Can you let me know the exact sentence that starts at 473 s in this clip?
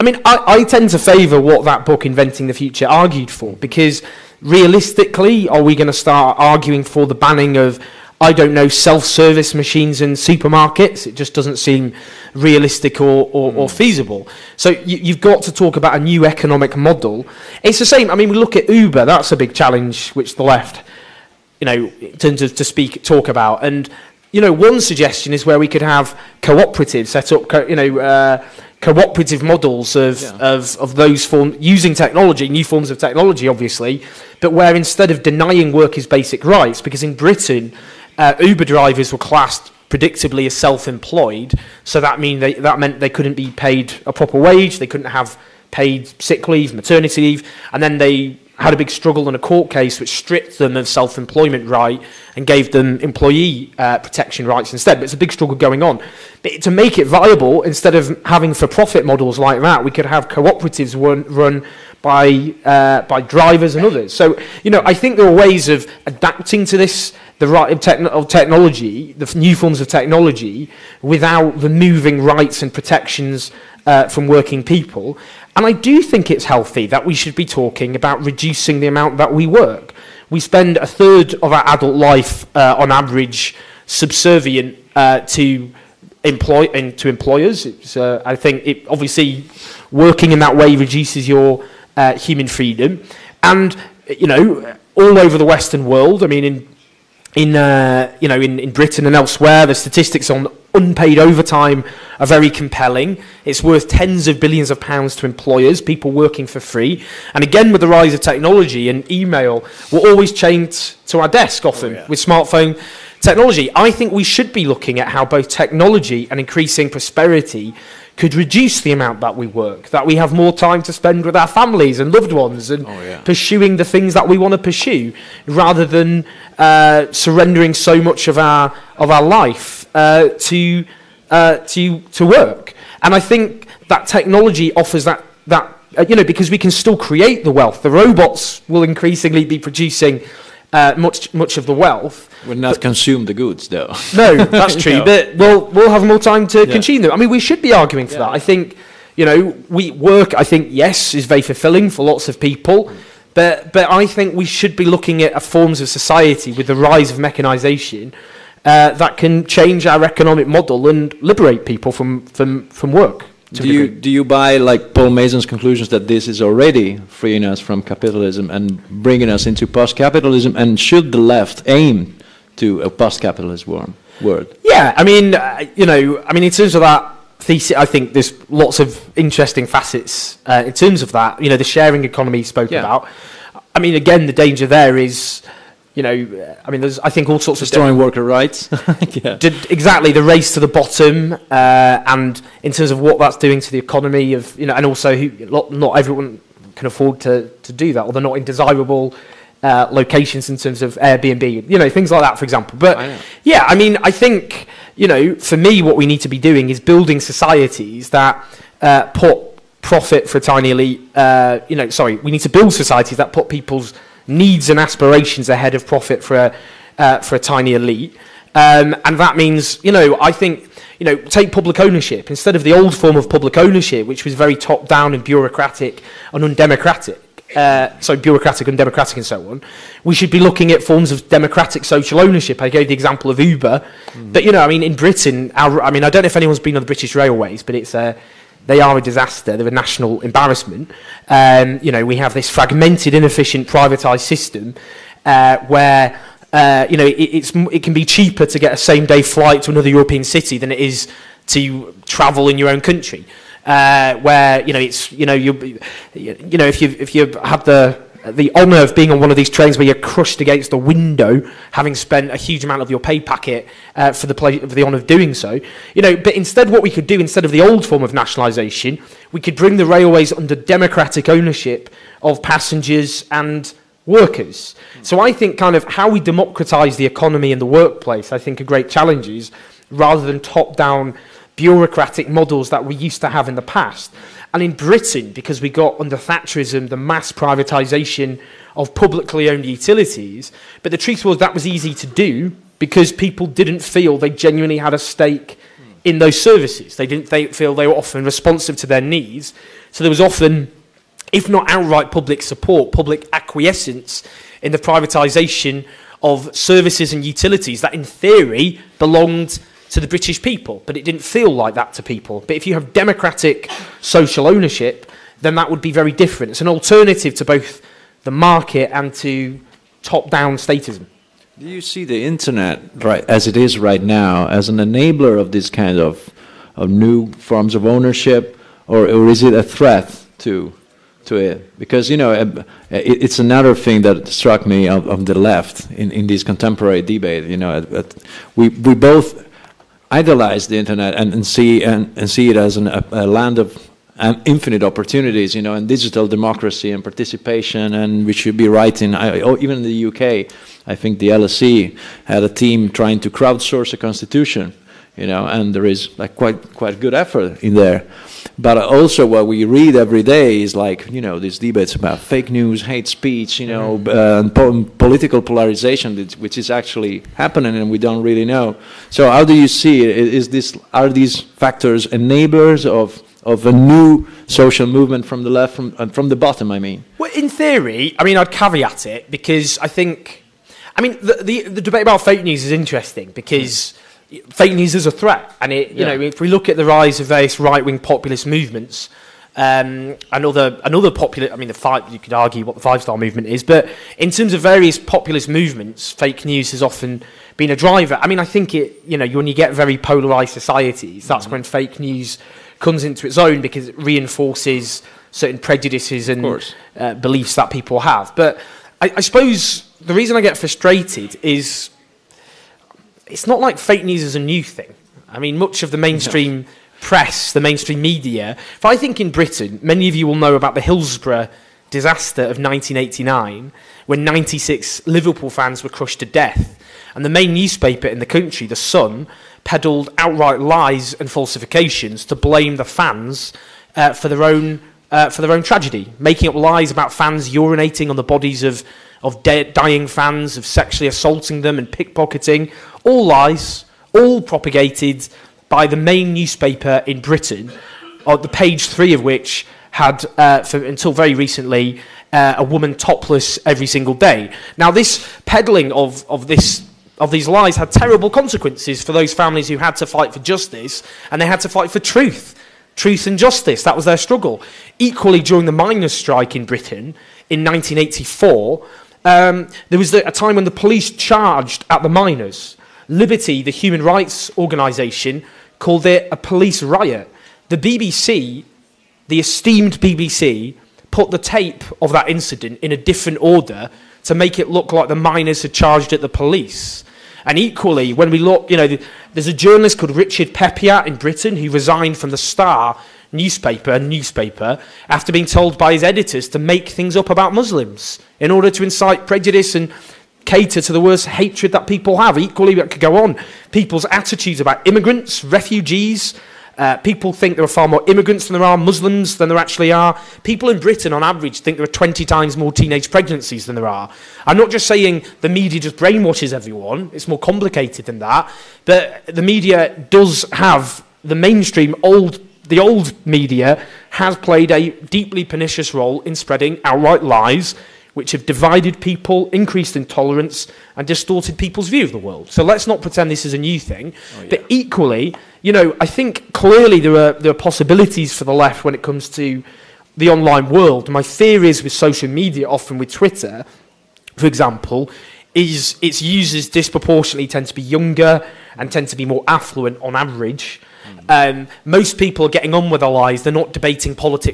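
Liberty, the human rights organisation, called it a police riot.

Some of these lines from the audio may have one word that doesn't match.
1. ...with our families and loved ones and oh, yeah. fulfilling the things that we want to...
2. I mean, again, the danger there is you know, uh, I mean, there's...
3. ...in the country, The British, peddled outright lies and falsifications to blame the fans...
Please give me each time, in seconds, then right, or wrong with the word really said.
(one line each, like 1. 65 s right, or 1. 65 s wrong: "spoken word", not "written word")
1. 121 s wrong: "pursuing", not "fulfilling"
2. 183 s right
3. 428 s wrong: "Sun", not "British".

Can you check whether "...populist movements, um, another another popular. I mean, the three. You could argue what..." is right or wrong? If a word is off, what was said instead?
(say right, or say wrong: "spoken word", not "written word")
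wrong: "five", not "three".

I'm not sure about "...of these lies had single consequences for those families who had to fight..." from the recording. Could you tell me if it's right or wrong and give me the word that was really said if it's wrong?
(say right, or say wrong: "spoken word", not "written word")
wrong: "terrible", not "single".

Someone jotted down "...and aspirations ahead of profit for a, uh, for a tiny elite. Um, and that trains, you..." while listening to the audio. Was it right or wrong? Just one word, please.
wrong.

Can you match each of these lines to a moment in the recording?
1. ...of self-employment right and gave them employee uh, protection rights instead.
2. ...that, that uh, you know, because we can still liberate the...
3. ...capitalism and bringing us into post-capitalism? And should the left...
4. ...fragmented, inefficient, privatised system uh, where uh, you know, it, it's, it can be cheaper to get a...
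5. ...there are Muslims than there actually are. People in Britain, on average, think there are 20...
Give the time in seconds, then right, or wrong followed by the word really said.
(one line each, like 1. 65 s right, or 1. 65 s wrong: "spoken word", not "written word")
1. 50 s right
2. 135 s wrong: "create", not "liberate"
3. 167 s right
4. 242 s right
5. 508 s right.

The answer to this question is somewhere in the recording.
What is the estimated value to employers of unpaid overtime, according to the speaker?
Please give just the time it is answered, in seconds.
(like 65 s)
103 s.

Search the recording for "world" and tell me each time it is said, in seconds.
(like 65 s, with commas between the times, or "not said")
95 s, 173 s, 532 s, 540 s.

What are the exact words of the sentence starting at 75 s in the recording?
And I do think it's healthy that we should be talking about reducing the amount that we work.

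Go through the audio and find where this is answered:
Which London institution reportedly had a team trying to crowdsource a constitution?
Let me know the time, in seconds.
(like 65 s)
351 s.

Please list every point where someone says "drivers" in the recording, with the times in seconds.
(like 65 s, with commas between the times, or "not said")
38 s, 63 s, 397 s.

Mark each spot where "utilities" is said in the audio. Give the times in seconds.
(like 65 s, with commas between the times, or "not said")
289 s, 307 s.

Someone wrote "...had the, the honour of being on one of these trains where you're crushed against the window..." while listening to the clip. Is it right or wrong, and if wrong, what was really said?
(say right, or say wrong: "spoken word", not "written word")
right.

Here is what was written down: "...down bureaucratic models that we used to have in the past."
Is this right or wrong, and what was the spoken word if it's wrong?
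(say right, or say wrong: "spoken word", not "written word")
right.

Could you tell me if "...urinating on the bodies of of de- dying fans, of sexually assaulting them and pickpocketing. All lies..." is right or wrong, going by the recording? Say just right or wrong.
right.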